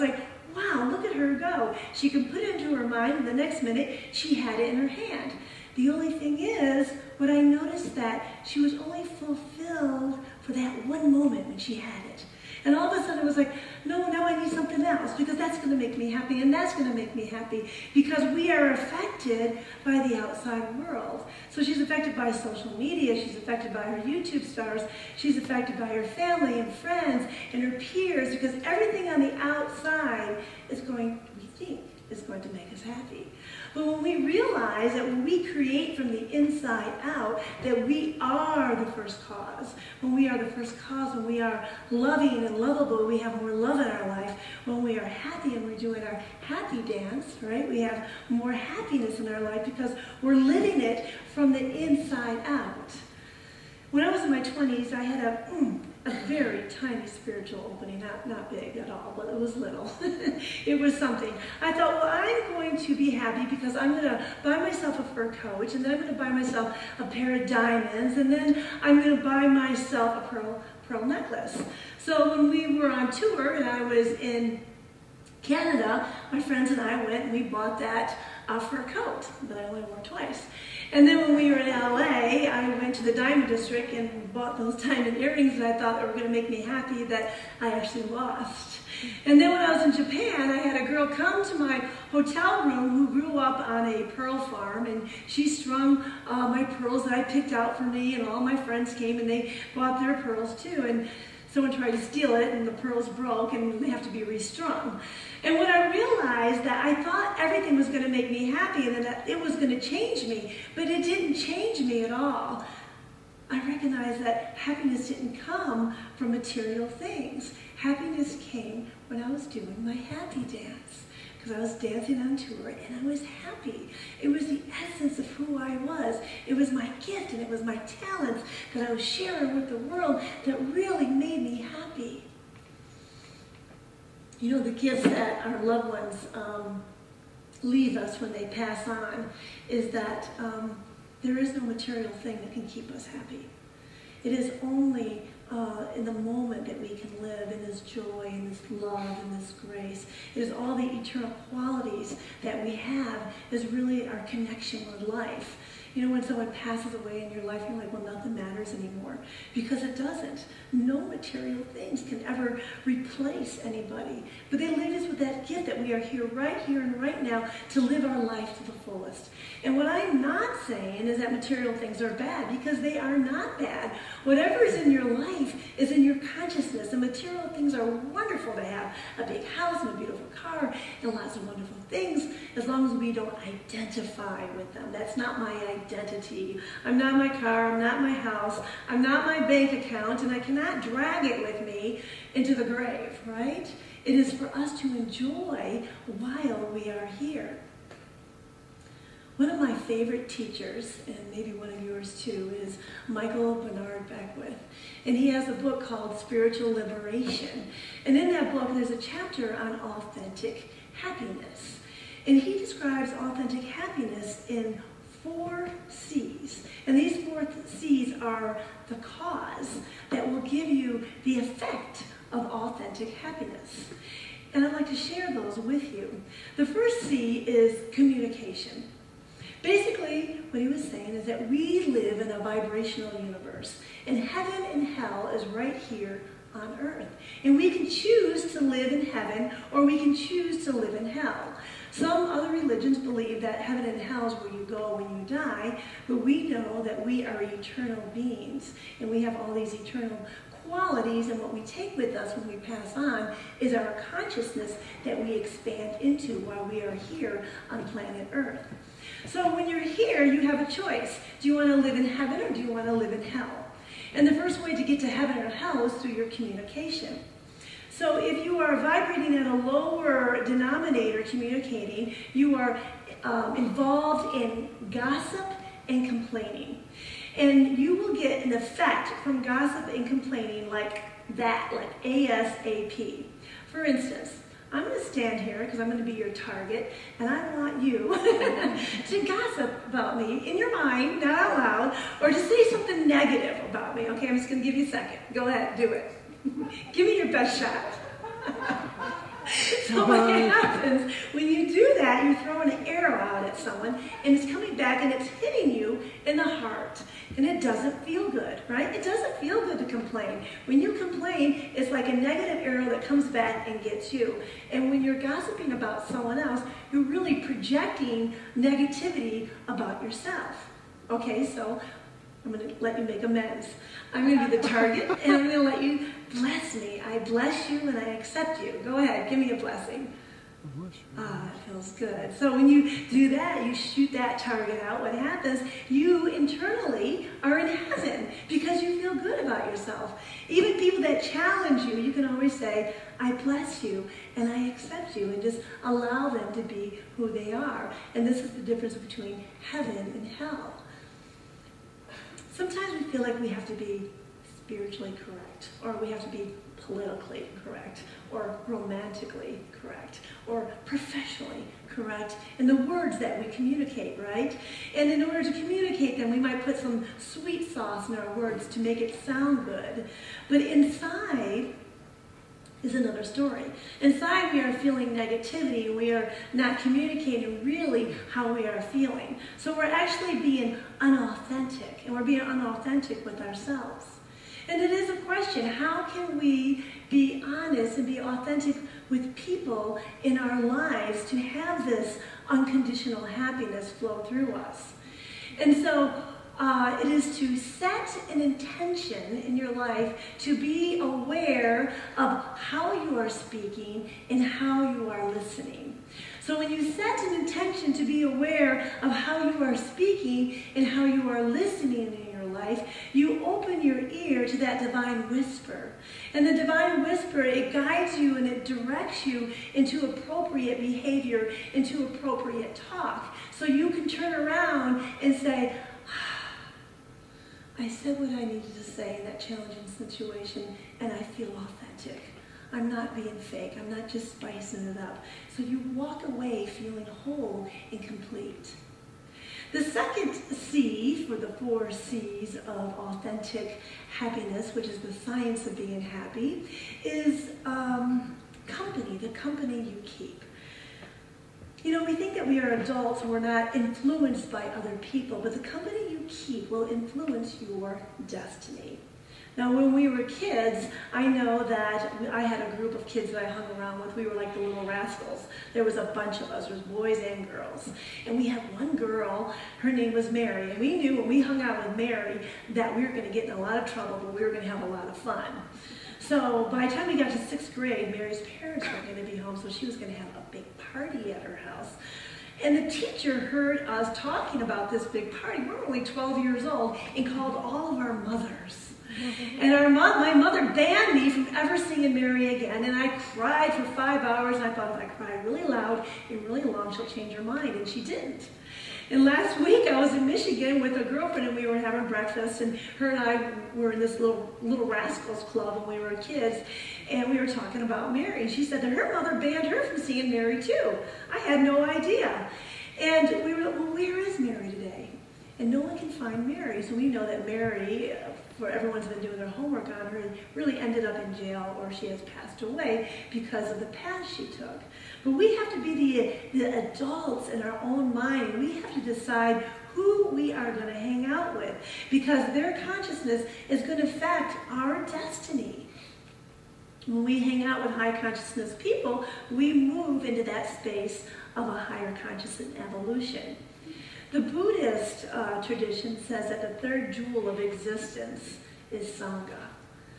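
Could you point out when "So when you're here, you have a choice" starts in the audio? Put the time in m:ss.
4:19.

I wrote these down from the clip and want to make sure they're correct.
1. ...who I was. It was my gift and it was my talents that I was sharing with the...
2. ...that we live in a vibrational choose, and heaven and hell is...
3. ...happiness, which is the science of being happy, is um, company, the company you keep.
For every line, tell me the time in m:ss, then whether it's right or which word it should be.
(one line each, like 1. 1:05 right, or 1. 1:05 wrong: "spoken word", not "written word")
1. 2:05 right
2. 3:51 wrong: "universe", not "choose"
3. 7:24 right.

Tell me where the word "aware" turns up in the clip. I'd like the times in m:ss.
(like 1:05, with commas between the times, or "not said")
6:40, 6:48.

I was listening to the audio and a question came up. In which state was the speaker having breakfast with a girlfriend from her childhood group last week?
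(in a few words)
Michigan.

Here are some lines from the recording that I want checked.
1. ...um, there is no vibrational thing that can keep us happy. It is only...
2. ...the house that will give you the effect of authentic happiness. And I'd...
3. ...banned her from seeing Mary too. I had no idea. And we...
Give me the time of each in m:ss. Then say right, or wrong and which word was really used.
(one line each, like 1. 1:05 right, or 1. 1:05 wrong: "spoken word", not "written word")
1. 2:20 wrong: "material", not "vibrational"
2. 3:38 wrong: "cause", not "house"
3. 8:29 right.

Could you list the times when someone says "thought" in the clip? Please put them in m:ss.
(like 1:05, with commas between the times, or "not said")
1:01, 1:25, 1:47, 8:14.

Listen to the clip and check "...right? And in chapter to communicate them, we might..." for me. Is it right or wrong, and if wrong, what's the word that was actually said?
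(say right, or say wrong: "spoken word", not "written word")
wrong: "order", not "chapter".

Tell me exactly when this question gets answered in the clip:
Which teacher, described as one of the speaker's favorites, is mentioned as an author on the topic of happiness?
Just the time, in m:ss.
3:23.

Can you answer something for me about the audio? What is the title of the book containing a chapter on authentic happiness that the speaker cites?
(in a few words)
Spiritual Liberation.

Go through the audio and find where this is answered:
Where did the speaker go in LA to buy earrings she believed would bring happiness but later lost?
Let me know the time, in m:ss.
1:23.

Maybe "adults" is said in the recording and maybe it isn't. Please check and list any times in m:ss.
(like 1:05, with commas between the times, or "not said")
7:32, 8:46.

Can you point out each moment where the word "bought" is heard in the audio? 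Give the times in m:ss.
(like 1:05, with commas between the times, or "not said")
1:17, 1:24, 1:39.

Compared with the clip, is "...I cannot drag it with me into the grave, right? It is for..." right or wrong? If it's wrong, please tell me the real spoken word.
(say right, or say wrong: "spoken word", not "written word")
right.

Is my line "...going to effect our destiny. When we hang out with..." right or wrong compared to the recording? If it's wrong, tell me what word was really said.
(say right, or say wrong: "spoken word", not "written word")
wrong: "affect", not "effect".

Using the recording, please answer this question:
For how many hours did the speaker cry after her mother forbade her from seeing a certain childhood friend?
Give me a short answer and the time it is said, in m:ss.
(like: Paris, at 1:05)
5, at 8:13.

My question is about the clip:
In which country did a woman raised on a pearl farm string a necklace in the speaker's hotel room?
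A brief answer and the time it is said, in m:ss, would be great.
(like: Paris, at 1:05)
Japan, at 1:30.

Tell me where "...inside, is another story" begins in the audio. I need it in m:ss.
6:10.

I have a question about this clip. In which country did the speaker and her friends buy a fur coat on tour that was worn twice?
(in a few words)
Canada.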